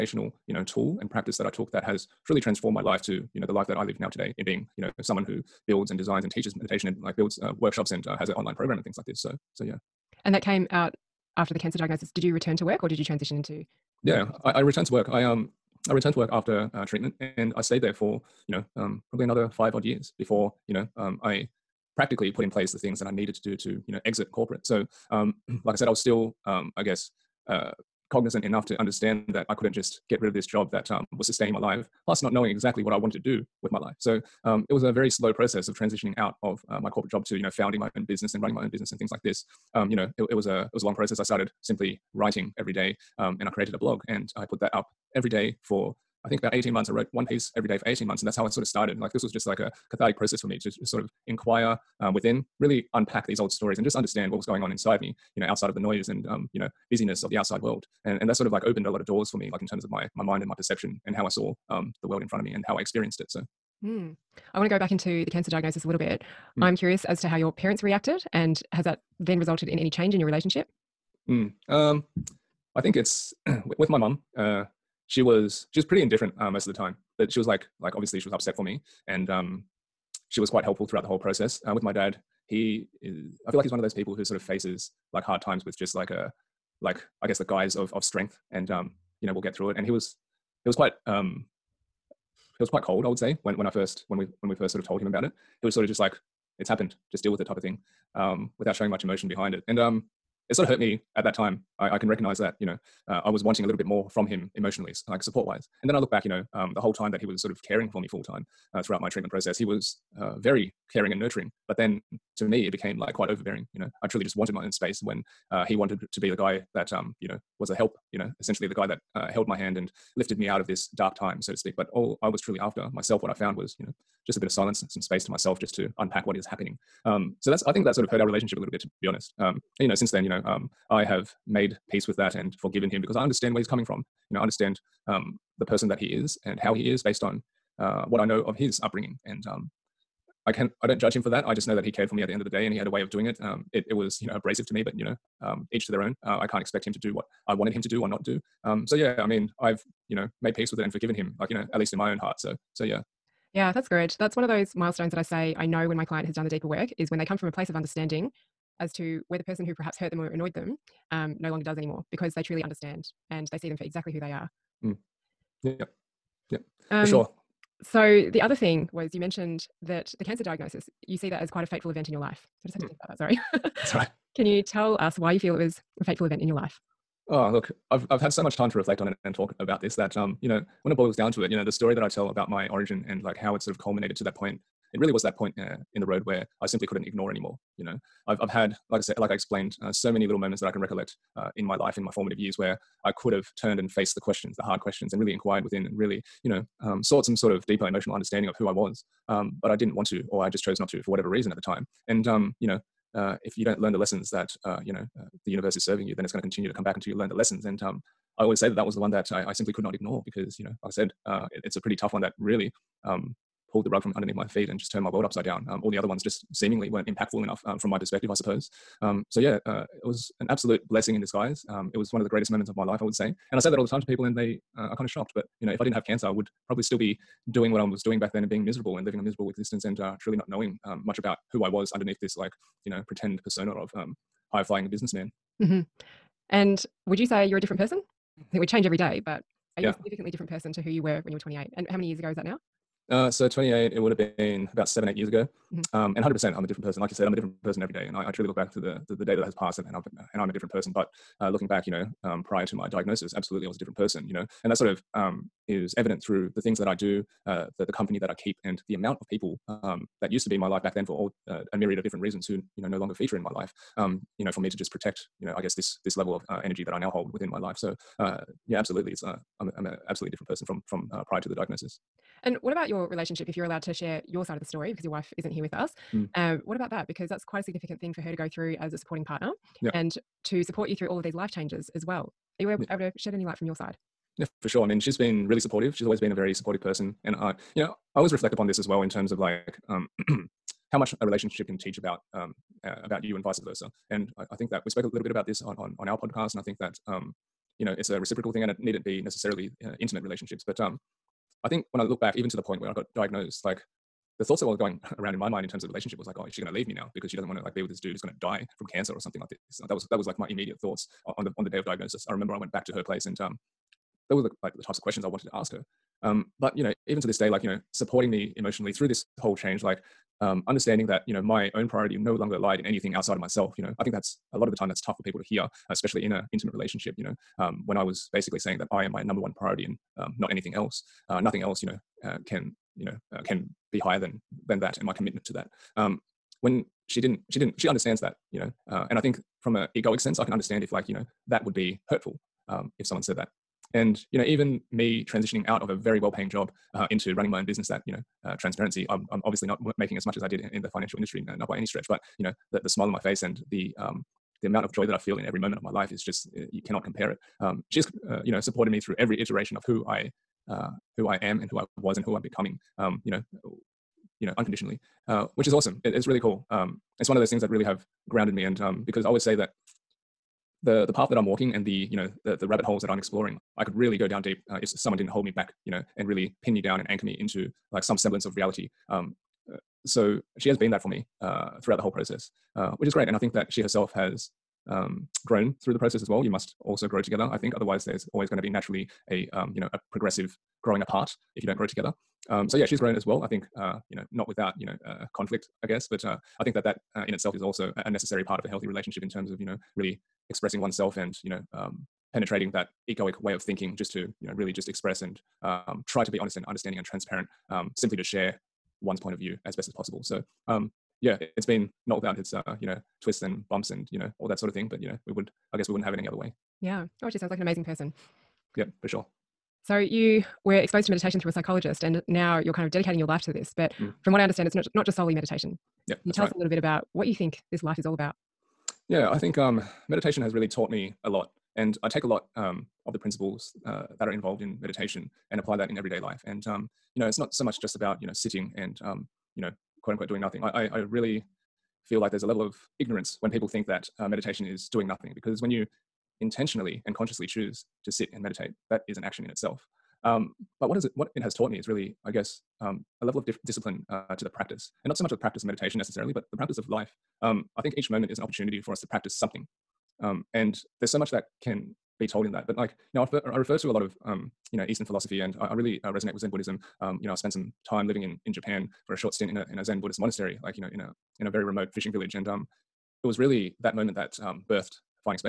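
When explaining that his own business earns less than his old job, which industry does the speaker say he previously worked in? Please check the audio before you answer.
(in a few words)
financial industry.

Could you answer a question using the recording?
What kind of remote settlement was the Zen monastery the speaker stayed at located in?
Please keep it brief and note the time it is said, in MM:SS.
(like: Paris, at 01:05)
fishing village, at 07:51.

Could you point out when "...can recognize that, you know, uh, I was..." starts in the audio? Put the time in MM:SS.
01:41.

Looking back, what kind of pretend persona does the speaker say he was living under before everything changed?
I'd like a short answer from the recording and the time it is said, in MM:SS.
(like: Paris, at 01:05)
high flying businessman, at 03:54.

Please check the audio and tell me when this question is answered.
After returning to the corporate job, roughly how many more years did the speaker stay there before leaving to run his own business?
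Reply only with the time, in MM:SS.
00:19.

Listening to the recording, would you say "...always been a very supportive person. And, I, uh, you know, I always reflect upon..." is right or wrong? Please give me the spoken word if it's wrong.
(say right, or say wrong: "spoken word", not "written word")
right.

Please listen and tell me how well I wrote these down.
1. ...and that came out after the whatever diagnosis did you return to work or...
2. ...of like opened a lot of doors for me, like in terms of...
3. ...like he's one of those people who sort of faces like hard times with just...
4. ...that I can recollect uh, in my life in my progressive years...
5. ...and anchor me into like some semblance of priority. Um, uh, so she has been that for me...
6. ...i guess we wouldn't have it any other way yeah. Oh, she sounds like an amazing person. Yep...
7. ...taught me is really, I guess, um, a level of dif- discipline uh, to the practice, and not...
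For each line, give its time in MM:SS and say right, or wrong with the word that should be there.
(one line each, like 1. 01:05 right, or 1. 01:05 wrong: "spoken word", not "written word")
1. 00:10 wrong: "cancer", not "whatever"
2. 00:58 right
3. 01:23 right
4. 03:10 wrong: "formative", not "progressive"
5. 06:16 wrong: "reality", not "priority"
6. 06:55 right
7. 07:31 right.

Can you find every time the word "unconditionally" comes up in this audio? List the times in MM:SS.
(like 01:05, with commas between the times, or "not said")
06:04.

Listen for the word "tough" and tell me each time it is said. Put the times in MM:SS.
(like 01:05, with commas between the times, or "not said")
03:31, 05:25.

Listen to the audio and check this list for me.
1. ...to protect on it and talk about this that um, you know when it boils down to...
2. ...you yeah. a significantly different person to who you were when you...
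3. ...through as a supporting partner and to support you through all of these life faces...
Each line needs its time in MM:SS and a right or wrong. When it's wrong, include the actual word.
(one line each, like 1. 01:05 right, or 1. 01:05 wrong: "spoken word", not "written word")
1. 02:58 wrong: "reflect", not "protect"
2. 03:59 right
3. 04:38 wrong: "changes", not "faces".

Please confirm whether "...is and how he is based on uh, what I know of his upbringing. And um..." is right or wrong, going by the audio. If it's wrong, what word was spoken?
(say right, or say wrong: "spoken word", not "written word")
right.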